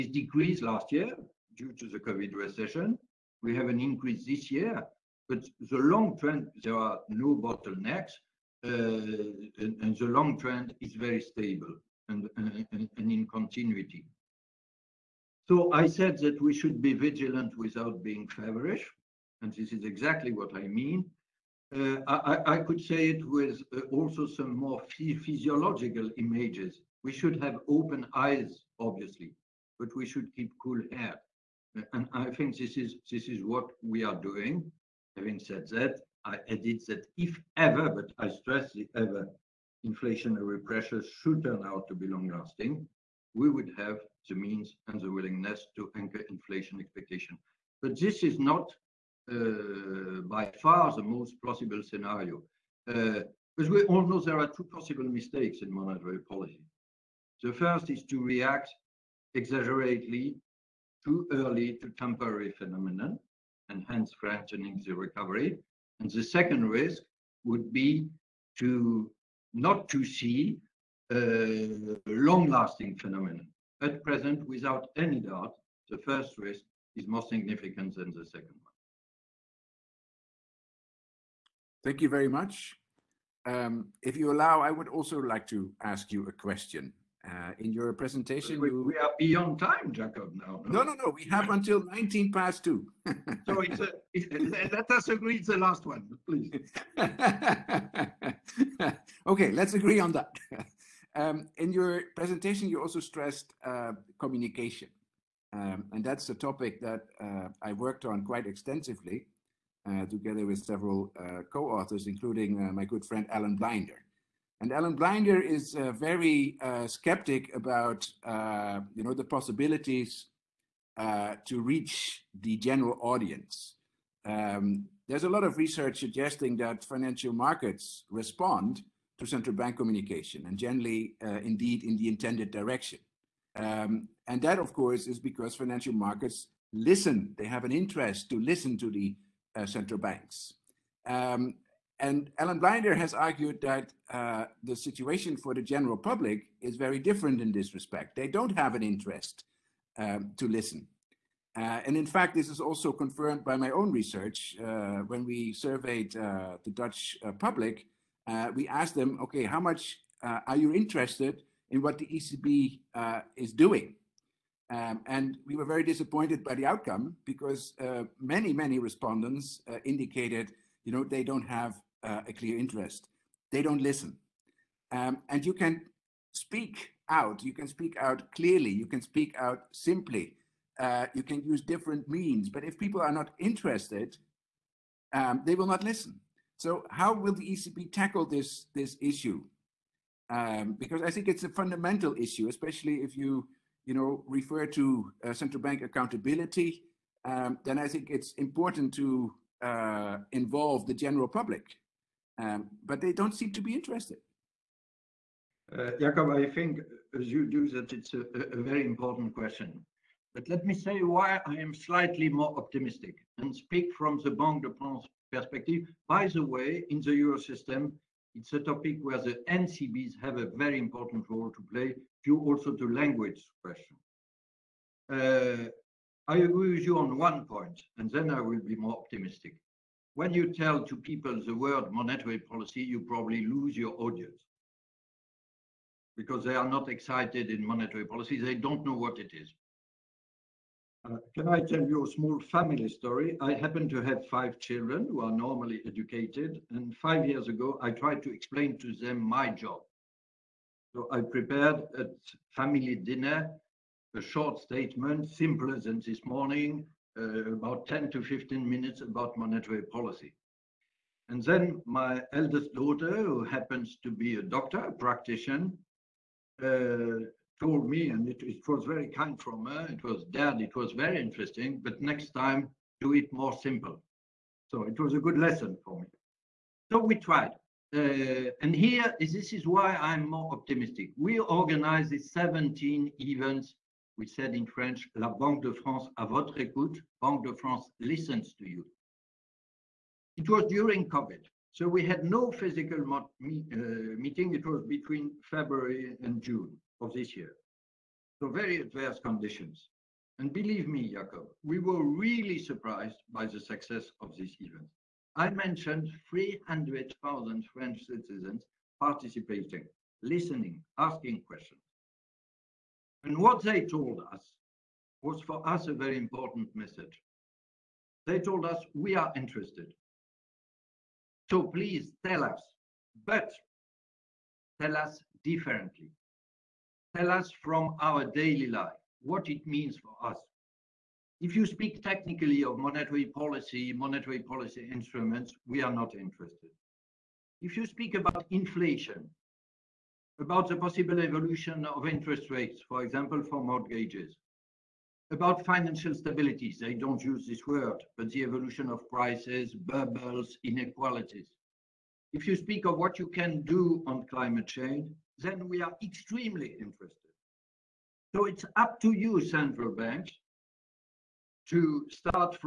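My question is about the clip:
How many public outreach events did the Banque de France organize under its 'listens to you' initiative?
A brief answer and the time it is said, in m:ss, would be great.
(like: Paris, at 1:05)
17, at 4:42.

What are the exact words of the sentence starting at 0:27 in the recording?
We should have open eyes, obviously, but we should keep cool head.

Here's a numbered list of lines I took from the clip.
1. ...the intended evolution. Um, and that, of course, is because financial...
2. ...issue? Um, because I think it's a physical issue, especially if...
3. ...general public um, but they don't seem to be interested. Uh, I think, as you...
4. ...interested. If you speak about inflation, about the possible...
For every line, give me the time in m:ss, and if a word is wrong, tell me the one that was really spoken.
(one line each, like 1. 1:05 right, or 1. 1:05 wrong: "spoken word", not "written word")
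1. 2:11 wrong: "direction", not "evolution"
2. 3:09 wrong: "fundamental", not "physical"
3. 3:20 right
4. 5:36 right.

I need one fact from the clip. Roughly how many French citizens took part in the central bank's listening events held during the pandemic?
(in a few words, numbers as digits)
300,000.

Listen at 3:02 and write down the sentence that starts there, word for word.
But if people are not interested, um, they will not listen.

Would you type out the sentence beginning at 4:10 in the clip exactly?
So I prepared at family dinner a short statement, simpler than this morning, uh, about 10 to 15 minutes about monetary policy.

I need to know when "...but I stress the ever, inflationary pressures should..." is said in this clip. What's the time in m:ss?
0:37.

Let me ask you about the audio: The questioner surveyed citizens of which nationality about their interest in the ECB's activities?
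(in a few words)
Dutch.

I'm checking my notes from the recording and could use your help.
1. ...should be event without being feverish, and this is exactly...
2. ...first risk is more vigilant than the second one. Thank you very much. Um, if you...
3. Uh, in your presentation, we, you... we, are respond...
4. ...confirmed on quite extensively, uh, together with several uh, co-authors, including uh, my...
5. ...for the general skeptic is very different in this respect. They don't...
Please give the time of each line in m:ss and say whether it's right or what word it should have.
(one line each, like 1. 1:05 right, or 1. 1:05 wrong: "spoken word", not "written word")
1. 0:16 wrong: "vigilant", not "event"
2. 1:15 wrong: "significant", not "vigilant"
3. 1:27 wrong: "beyond", not "respond"
4. 1:47 wrong: "worked", not "confirmed"
5. 2:25 wrong: "public", not "skeptic".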